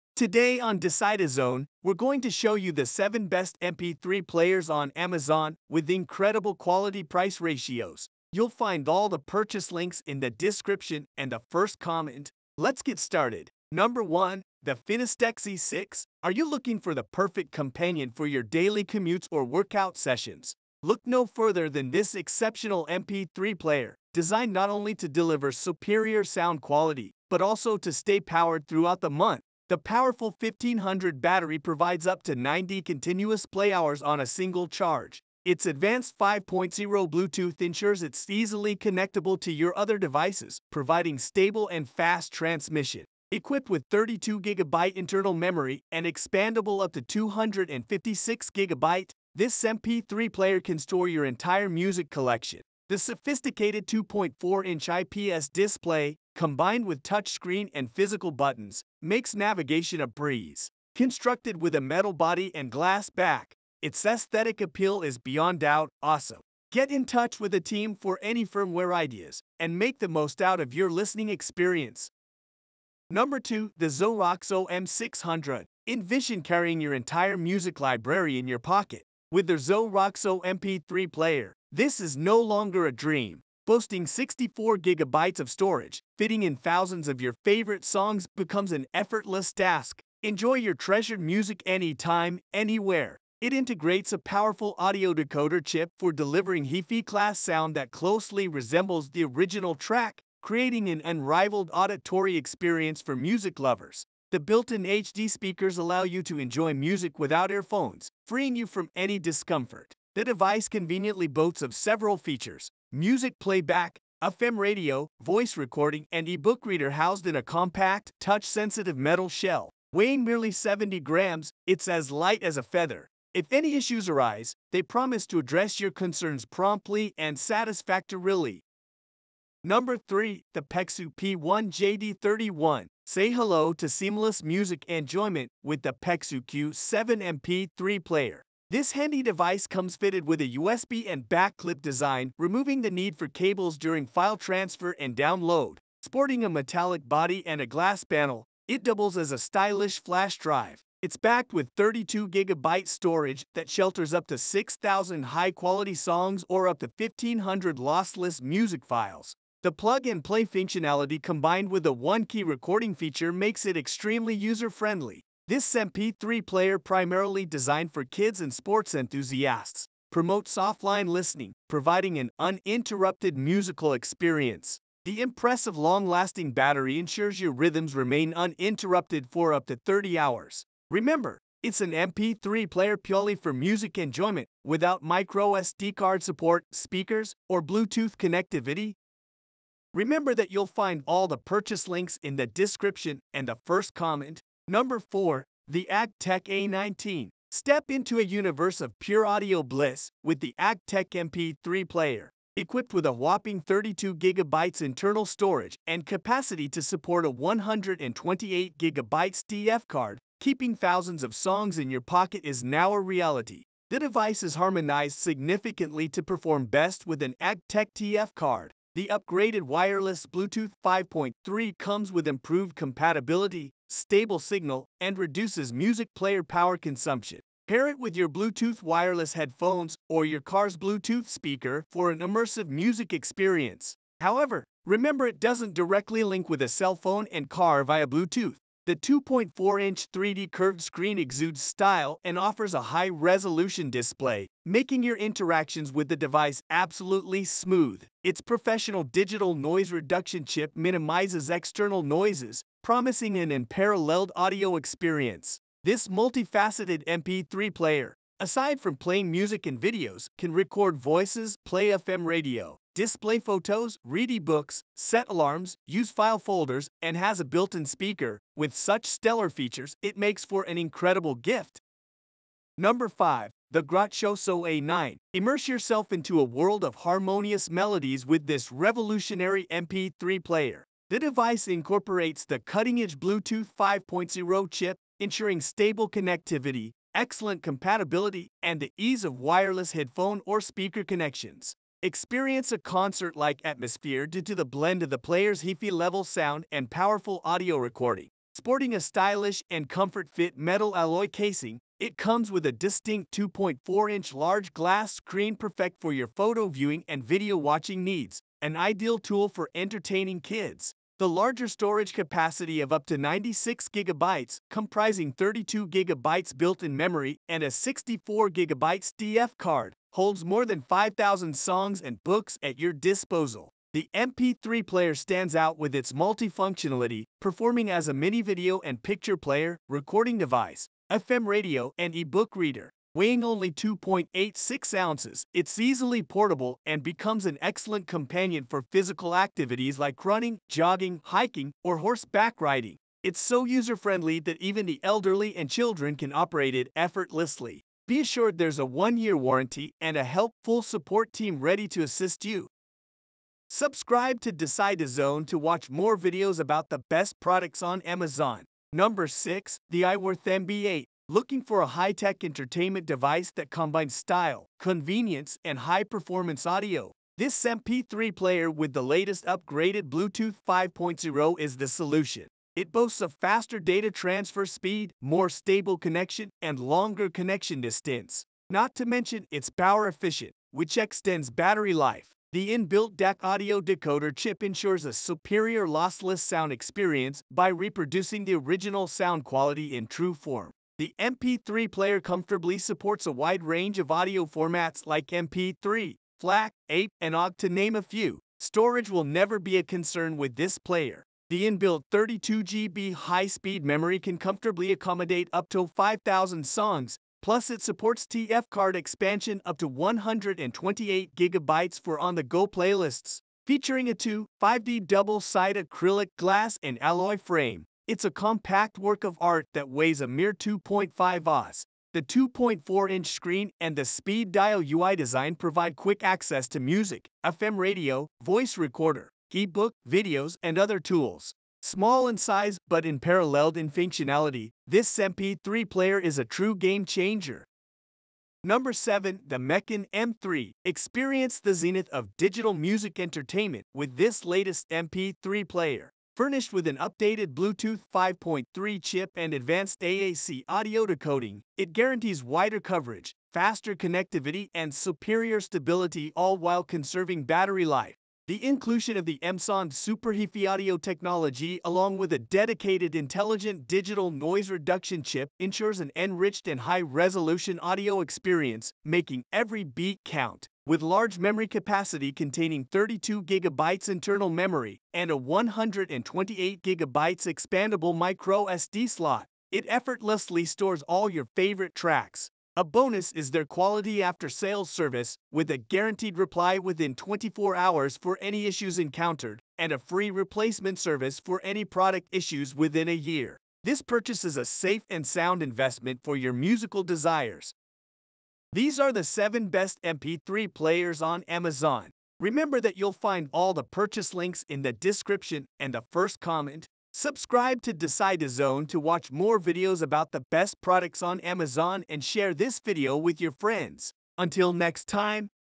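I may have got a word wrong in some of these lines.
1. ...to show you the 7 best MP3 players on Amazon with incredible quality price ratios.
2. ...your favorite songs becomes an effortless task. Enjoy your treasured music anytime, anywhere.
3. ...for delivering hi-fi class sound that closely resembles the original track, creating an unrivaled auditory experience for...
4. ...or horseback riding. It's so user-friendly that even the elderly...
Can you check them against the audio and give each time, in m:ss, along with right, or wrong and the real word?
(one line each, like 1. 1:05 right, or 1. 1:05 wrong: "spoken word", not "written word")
1. 0:02 right
2. 1:27 right
3. 1:35 right
4. 5:41 right.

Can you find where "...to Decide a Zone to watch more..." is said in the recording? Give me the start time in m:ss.
5:54.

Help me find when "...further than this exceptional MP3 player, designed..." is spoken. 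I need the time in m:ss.
0:21.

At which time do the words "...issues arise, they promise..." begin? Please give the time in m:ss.
2:03.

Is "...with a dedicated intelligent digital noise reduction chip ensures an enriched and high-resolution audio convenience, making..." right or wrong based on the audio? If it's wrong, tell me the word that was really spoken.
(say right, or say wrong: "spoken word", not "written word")
wrong: "experience", not "convenience".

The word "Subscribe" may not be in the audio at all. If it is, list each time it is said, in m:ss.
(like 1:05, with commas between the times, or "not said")
5:53, 8:27.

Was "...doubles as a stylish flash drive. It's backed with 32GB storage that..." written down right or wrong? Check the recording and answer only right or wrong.
right.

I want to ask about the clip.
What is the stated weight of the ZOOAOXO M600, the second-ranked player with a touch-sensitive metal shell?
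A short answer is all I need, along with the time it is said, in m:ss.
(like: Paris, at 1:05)
70 grams, at 2:00.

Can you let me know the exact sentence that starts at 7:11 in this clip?
Small in size but unparalleled in functionality, this MP3 player is a true game changer.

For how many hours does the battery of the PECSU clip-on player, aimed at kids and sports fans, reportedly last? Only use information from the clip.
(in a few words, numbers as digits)
30 hours.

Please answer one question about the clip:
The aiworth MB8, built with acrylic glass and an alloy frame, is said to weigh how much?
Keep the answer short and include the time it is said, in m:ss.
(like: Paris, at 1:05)
2.5 oz, at 7:00.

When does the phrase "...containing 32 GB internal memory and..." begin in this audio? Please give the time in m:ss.
7:52.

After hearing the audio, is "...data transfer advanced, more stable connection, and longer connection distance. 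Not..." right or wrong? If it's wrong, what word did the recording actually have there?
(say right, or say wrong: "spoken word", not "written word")
wrong: "speed", not "advanced".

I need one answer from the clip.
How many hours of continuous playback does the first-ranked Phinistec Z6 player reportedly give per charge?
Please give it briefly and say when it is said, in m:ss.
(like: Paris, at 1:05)
90, at 0:32.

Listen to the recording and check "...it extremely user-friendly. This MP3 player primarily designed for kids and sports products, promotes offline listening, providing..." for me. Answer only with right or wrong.
wrong.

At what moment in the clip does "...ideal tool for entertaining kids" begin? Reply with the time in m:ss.
5:08.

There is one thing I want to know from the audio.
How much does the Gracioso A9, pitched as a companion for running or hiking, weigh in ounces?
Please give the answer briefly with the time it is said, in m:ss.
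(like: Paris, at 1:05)
2.86 ounces, at 5:33.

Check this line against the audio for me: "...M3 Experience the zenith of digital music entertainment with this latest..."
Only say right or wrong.
right.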